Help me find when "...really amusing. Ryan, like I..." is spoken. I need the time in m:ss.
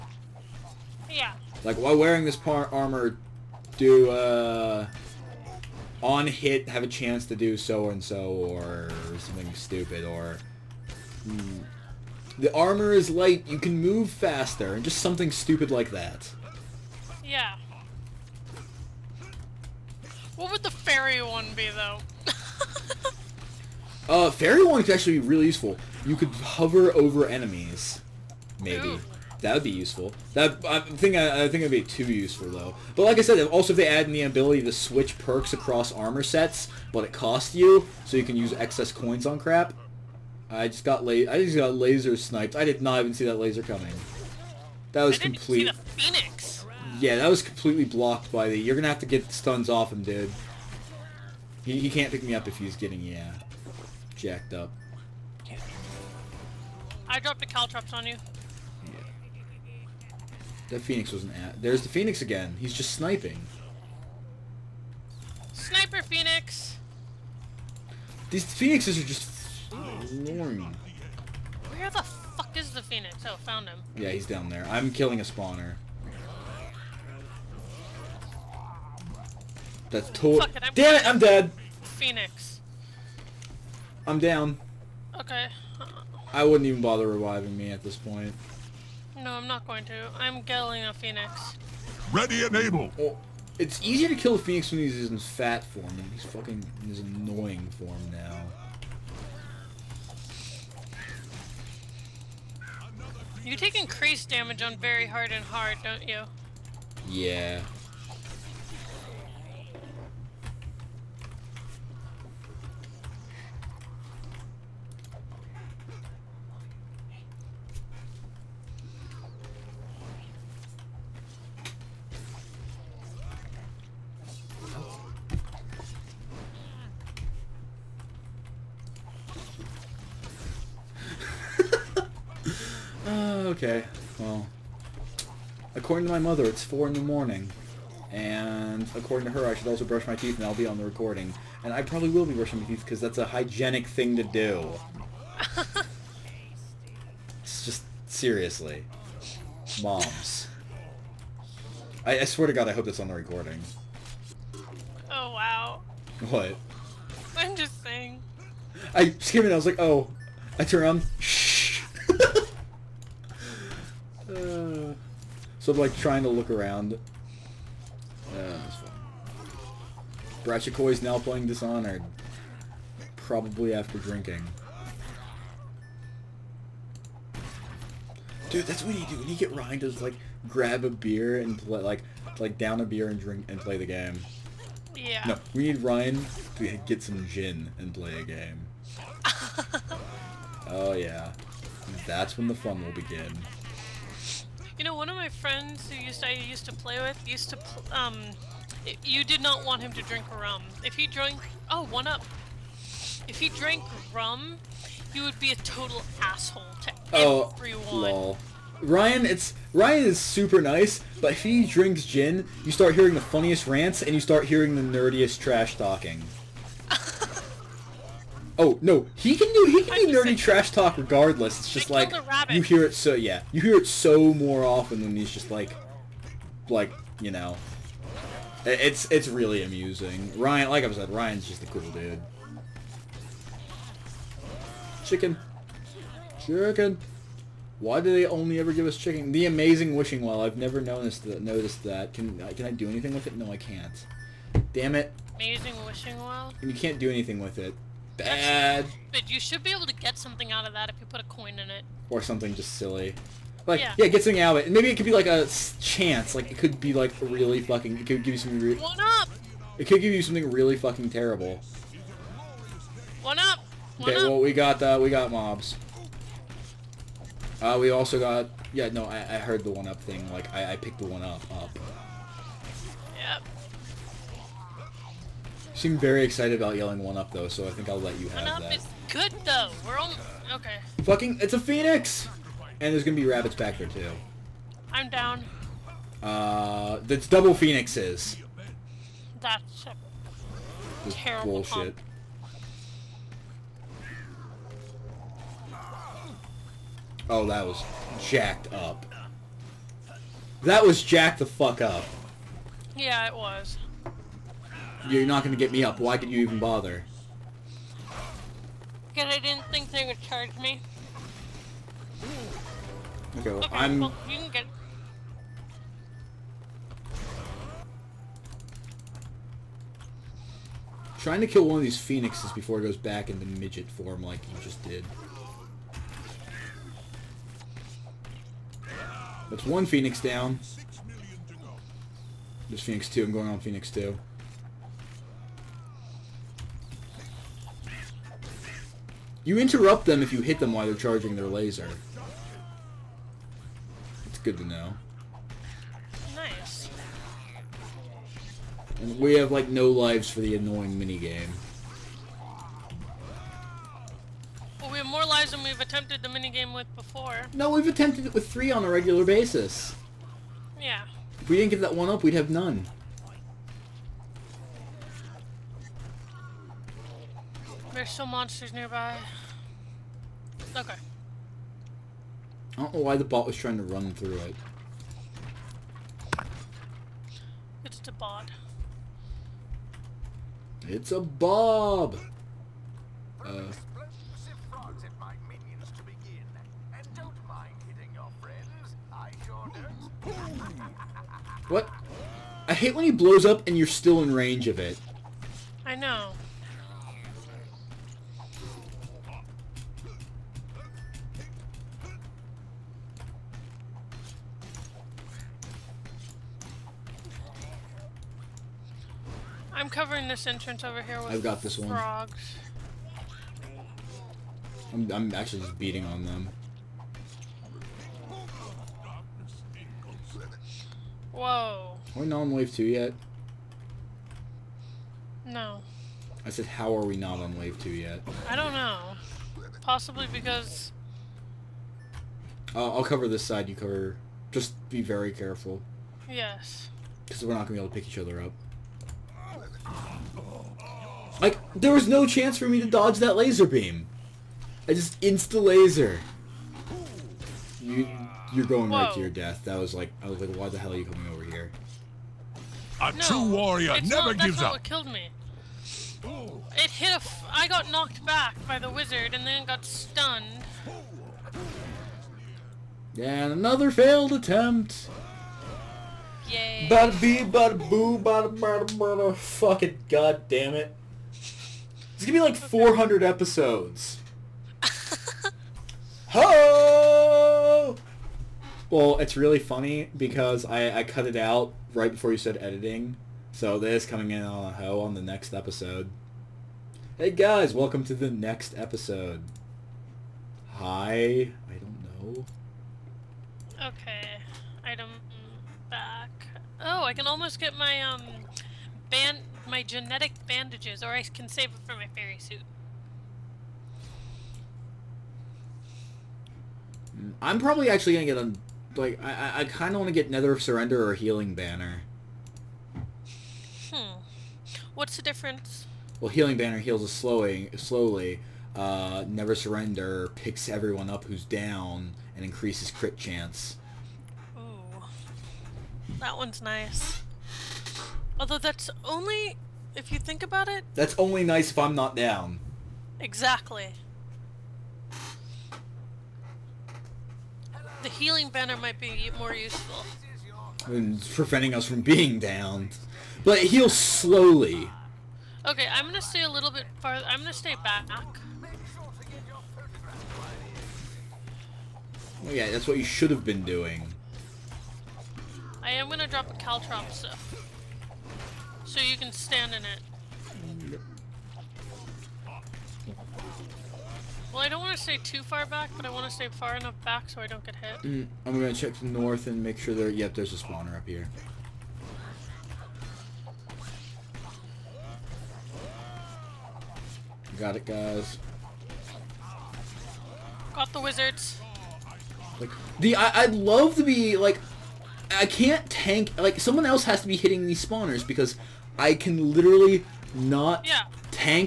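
3:49.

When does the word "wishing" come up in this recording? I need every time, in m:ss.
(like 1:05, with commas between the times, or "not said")
3:59, 4:05.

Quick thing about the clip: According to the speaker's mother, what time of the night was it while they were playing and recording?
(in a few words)
4 in the morning.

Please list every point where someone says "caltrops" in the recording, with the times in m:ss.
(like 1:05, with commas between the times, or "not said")
0:57, 9:16.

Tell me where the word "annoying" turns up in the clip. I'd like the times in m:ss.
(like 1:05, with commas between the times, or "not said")
1:36, 5:50.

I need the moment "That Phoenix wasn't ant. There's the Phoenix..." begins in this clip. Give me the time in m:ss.
1:00.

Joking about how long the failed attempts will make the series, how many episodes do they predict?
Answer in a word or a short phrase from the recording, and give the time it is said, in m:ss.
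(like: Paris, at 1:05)
400, at 7:52.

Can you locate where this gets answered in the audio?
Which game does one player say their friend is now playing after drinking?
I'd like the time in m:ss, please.
2:51.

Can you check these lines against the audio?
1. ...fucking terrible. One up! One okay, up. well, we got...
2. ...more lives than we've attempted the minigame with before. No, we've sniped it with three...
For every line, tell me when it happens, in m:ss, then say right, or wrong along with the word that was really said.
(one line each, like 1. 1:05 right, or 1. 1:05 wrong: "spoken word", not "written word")
1. 4:20 right
2. 5:55 wrong: "attempted", not "sniped".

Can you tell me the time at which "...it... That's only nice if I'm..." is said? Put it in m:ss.
8:50.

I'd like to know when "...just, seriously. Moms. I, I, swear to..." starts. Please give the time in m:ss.
2:27.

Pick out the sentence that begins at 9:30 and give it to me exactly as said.
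Yep, there's a spawner up here.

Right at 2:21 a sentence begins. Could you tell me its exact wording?
And I probably will be brushing my teeth because that's a hygienic thing to do.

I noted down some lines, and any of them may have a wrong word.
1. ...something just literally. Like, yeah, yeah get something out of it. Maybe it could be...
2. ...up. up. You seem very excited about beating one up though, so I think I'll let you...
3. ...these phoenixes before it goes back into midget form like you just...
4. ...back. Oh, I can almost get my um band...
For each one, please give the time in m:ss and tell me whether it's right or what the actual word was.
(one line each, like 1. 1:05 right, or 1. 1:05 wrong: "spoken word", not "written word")
1. 4:12 wrong: "silly", not "literally"
2. 4:31 wrong: "yelling", not "beating"
3. 5:21 right
4. 8:15 right.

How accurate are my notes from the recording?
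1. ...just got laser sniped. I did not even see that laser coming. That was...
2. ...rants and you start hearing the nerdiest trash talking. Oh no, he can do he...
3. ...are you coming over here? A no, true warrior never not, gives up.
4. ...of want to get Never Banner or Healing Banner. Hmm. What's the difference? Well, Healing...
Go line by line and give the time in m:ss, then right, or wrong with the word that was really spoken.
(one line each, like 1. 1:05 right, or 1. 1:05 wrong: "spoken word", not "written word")
1. 0:41 right
2. 3:33 right
3. 7:30 right
4. 8:29 wrong: "Surrender", not "Banner".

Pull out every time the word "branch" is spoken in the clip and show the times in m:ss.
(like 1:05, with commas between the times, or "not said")
not said.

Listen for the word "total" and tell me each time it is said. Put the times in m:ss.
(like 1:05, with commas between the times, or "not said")
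1:20, 3:25.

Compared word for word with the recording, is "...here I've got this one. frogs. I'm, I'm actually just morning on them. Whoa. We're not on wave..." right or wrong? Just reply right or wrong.
wrong.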